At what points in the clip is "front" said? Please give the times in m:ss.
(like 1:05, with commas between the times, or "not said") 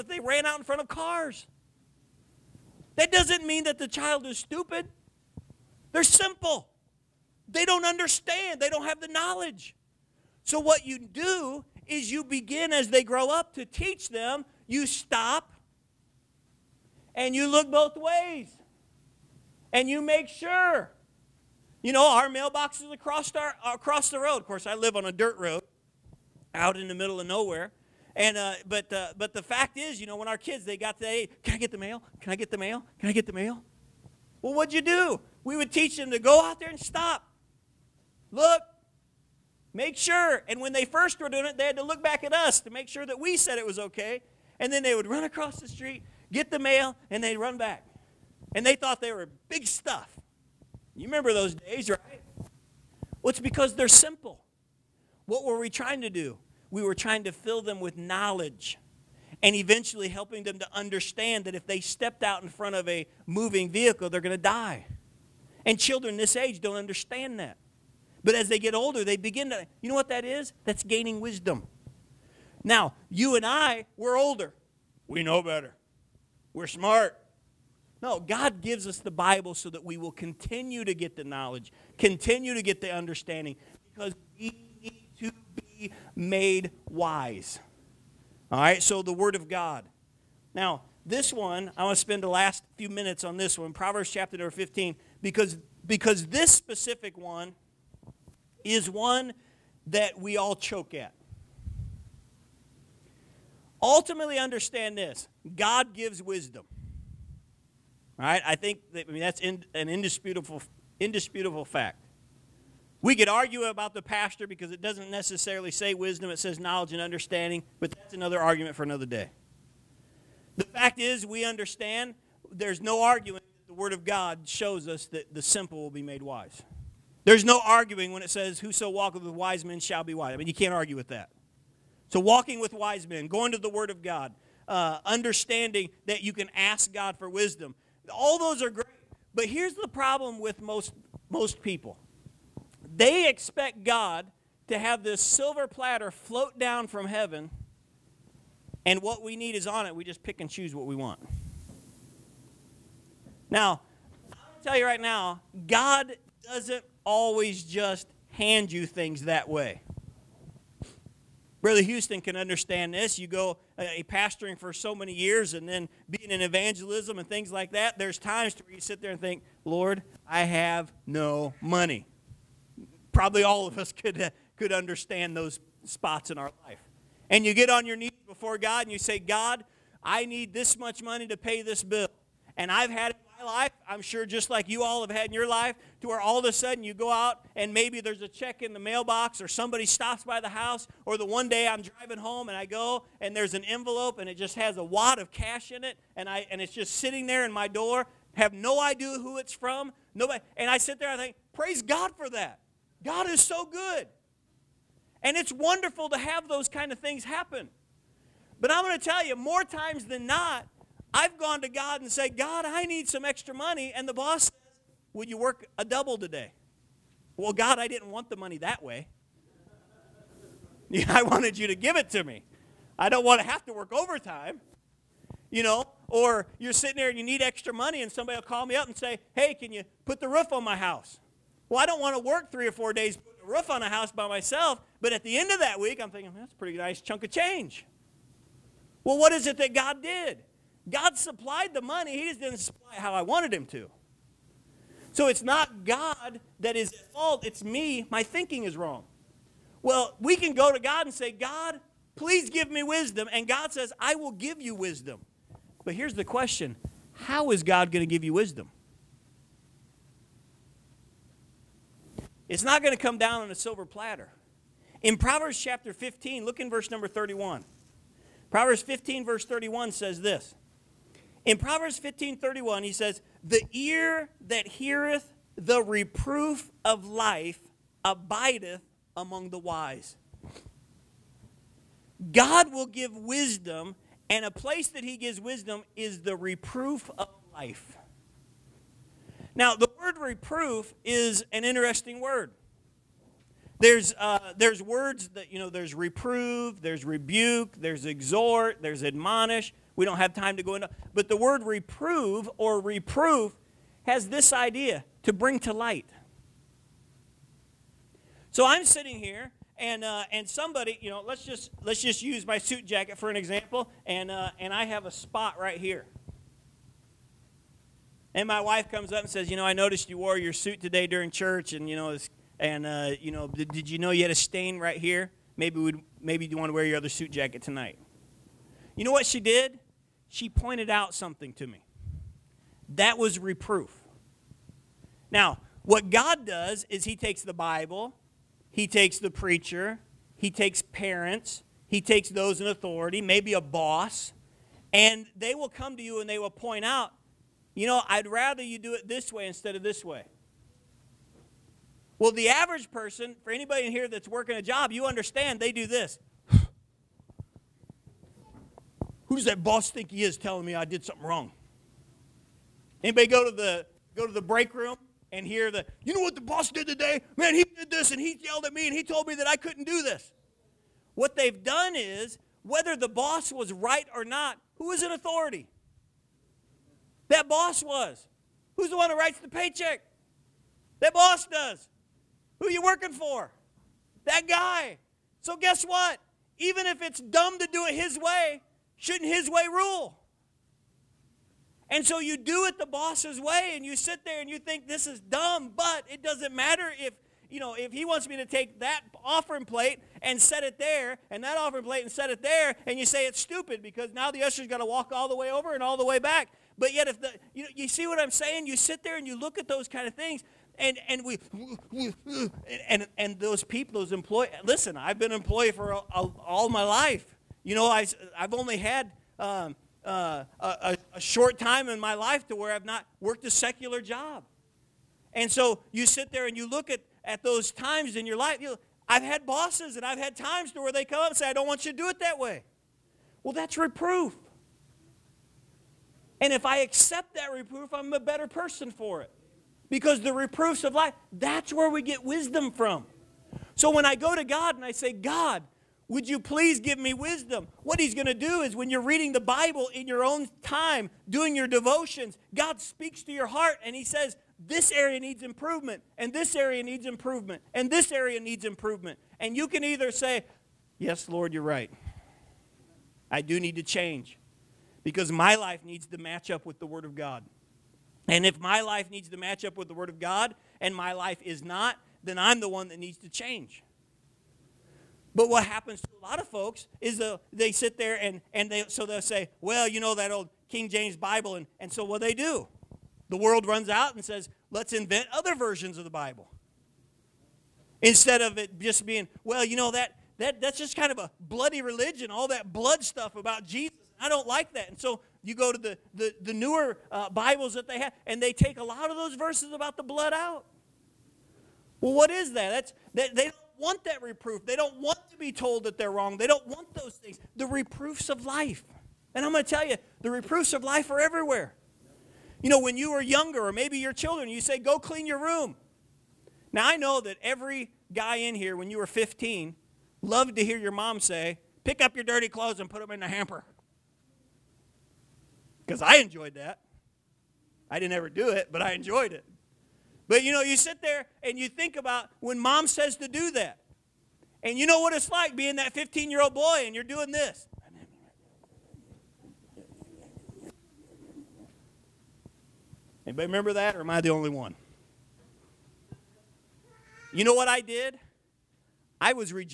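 0:00, 1:02.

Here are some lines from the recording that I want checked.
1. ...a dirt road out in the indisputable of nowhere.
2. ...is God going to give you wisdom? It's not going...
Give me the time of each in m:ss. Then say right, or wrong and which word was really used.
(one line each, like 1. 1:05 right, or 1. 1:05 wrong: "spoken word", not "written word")
1. 0:25 wrong: "middle", not "indisputable"
2. 4:17 right.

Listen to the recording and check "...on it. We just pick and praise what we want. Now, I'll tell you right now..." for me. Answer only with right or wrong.
wrong.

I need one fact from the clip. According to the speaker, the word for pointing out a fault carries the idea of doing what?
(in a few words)
Bring to light.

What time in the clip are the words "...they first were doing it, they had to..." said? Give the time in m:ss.
0:40.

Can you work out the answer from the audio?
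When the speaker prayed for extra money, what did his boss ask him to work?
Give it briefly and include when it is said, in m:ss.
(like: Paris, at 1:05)
A double, at 3:35.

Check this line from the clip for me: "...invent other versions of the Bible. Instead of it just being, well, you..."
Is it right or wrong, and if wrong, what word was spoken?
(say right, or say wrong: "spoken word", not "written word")
right.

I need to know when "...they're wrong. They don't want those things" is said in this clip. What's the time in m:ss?
8:25.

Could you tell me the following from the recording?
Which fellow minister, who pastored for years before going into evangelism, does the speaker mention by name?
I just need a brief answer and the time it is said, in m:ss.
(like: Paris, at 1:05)
Brother Houston, at 2:41.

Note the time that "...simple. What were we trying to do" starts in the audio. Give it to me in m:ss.
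0:53.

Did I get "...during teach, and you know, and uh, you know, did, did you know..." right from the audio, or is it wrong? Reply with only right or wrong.
wrong.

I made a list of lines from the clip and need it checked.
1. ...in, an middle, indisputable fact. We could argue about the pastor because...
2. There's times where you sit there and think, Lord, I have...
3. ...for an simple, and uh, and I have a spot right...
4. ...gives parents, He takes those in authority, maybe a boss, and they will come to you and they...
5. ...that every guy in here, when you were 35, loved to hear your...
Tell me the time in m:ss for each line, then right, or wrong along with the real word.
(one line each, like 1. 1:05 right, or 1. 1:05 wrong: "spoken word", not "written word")
1. 1:49 wrong: "indisputable", not "middle"
2. 2:47 right
3. 5:13 wrong: "example", not "simple"
4. 5:40 wrong: "takes", not "gives"
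5. 8:37 wrong: "15", not "35".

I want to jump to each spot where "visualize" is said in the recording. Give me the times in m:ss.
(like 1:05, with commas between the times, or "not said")
not said.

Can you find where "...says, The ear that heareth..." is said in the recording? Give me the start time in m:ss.
4:32.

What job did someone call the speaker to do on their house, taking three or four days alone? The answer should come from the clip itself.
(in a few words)
Put the roof on.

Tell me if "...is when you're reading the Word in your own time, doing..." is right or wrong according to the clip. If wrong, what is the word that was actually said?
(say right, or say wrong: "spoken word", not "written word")
wrong: "Bible", not "Word".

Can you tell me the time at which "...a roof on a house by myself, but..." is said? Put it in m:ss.
3:53.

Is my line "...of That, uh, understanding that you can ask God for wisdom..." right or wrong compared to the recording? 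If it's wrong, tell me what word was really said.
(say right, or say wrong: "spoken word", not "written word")
wrong: "God", not "That".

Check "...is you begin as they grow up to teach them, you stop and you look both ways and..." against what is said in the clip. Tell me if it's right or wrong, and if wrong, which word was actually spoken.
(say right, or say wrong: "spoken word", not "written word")
right.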